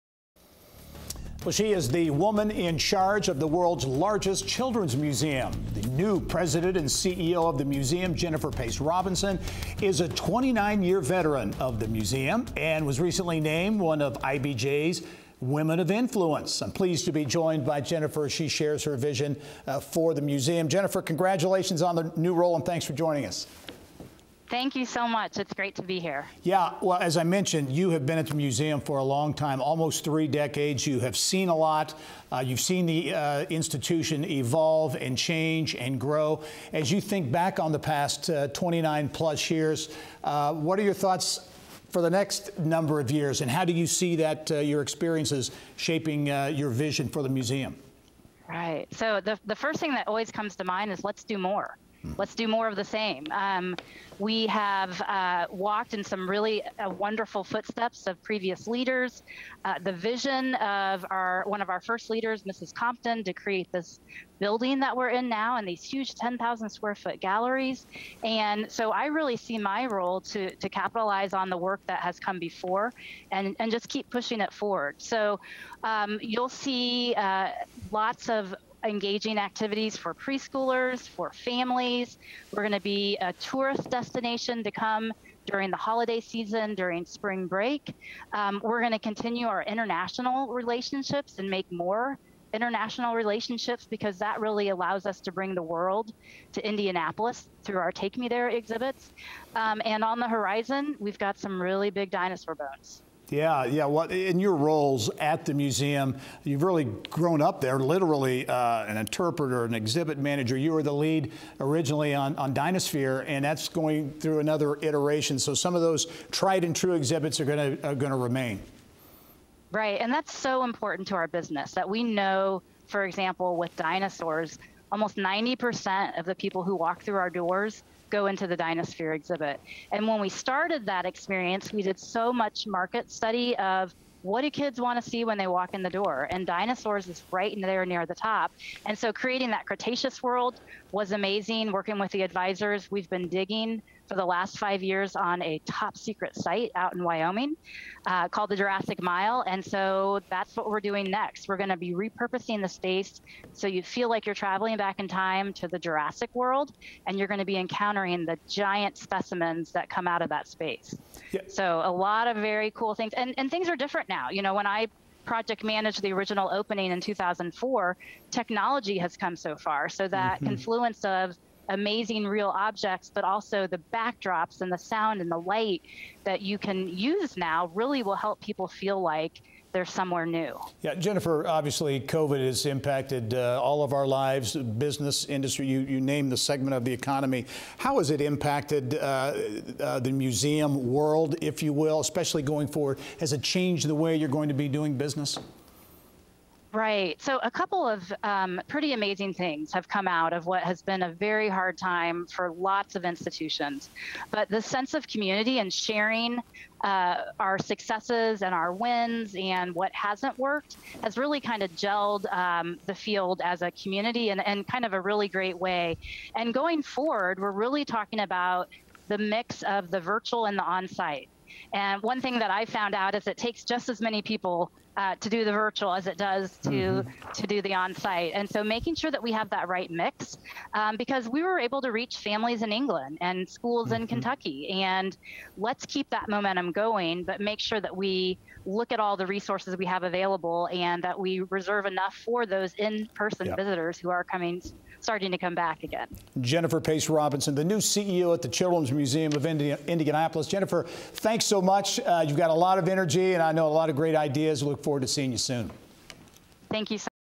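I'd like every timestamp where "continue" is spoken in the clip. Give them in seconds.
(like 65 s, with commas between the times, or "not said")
88 s.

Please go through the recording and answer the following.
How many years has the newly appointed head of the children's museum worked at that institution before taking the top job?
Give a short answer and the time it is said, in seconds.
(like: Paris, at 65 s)
29, at 10 s.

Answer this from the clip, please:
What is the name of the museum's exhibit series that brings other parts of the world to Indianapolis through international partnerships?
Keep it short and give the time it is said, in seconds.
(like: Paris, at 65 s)
Take Me There, at 97 s.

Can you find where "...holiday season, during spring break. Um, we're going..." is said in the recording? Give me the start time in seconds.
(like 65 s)
85 s.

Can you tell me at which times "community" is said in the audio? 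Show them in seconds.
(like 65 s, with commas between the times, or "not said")
205 s, 213 s.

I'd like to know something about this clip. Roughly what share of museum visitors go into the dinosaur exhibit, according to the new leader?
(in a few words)
90%.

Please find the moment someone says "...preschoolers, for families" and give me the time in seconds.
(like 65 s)
80 s.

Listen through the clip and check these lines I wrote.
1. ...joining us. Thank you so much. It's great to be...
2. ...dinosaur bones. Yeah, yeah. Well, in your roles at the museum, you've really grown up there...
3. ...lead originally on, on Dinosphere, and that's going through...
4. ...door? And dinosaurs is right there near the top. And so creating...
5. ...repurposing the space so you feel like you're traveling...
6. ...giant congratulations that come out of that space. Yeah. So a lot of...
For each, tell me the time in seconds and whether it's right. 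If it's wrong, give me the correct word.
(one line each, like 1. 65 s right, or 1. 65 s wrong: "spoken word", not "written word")
1. 22 s right
2. 102 s right
3. 110 s right
4. 135 s right
5. 151 s right
6. 158 s wrong: "specimens", not "congratulations".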